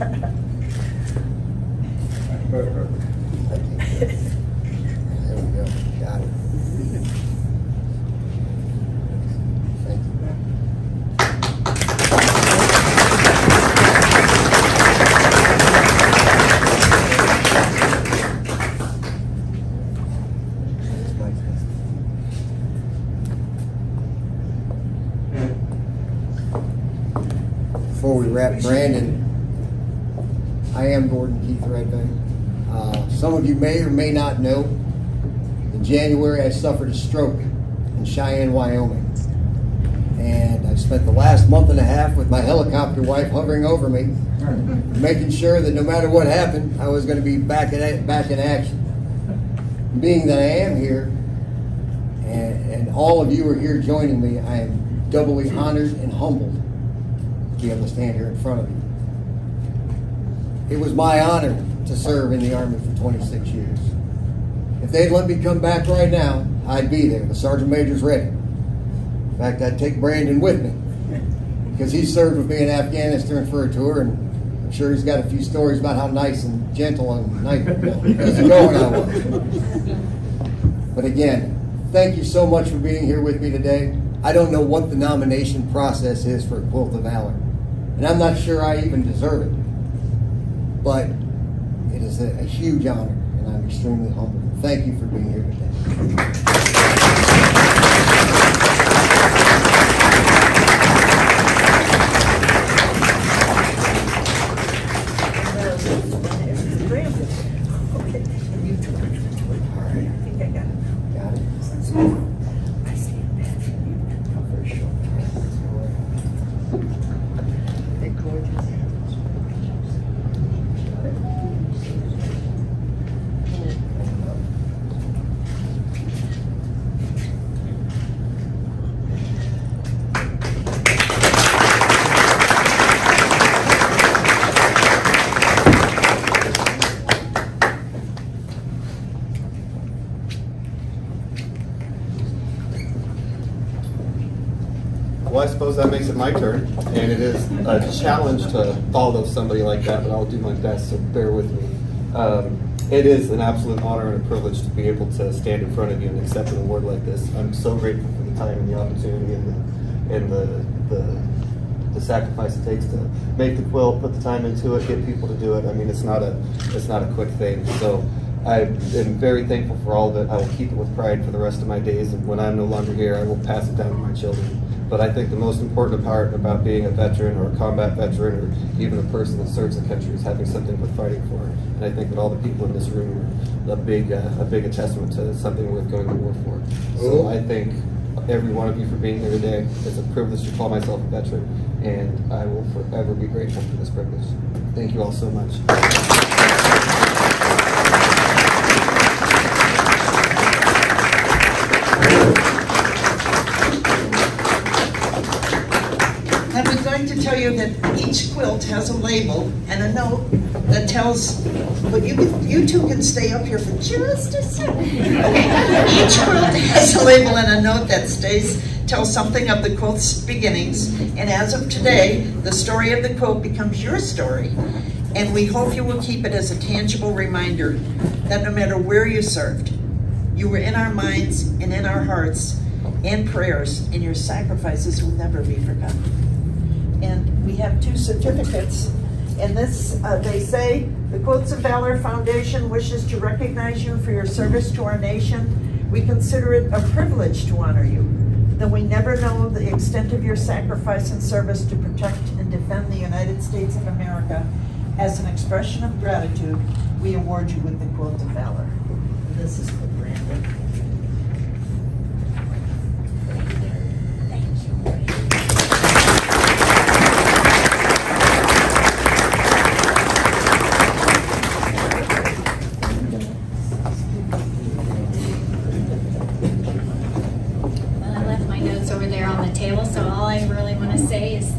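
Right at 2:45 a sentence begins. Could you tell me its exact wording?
I mean, it's not a, it's not a quick thing.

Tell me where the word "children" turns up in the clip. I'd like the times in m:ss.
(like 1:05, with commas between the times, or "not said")
2:54.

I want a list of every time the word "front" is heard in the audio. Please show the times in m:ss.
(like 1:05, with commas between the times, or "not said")
0:58, 2:35.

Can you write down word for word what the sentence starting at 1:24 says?
I don't know what the nomination process is for Quilt of Valor.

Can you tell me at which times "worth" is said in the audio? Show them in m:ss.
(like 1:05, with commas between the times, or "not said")
3:00, 3:05.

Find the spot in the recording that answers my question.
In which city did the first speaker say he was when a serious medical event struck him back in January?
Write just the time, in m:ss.
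0:38.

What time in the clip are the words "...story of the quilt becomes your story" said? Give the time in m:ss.
3:42.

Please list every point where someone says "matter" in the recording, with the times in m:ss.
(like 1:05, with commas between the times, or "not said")
0:45, 3:48.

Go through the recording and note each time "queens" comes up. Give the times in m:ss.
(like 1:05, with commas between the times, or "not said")
not said.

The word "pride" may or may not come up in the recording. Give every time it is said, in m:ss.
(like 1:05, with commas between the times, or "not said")
2:50.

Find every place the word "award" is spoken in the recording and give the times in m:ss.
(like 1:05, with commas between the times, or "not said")
2:36, 4:17.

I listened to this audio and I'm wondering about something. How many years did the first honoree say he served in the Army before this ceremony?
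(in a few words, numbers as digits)
26.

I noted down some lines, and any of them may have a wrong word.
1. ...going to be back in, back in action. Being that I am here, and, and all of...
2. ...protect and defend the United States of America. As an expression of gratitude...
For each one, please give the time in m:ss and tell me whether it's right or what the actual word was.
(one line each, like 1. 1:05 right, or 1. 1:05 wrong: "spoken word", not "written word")
1. 0:47 right
2. 4:11 right.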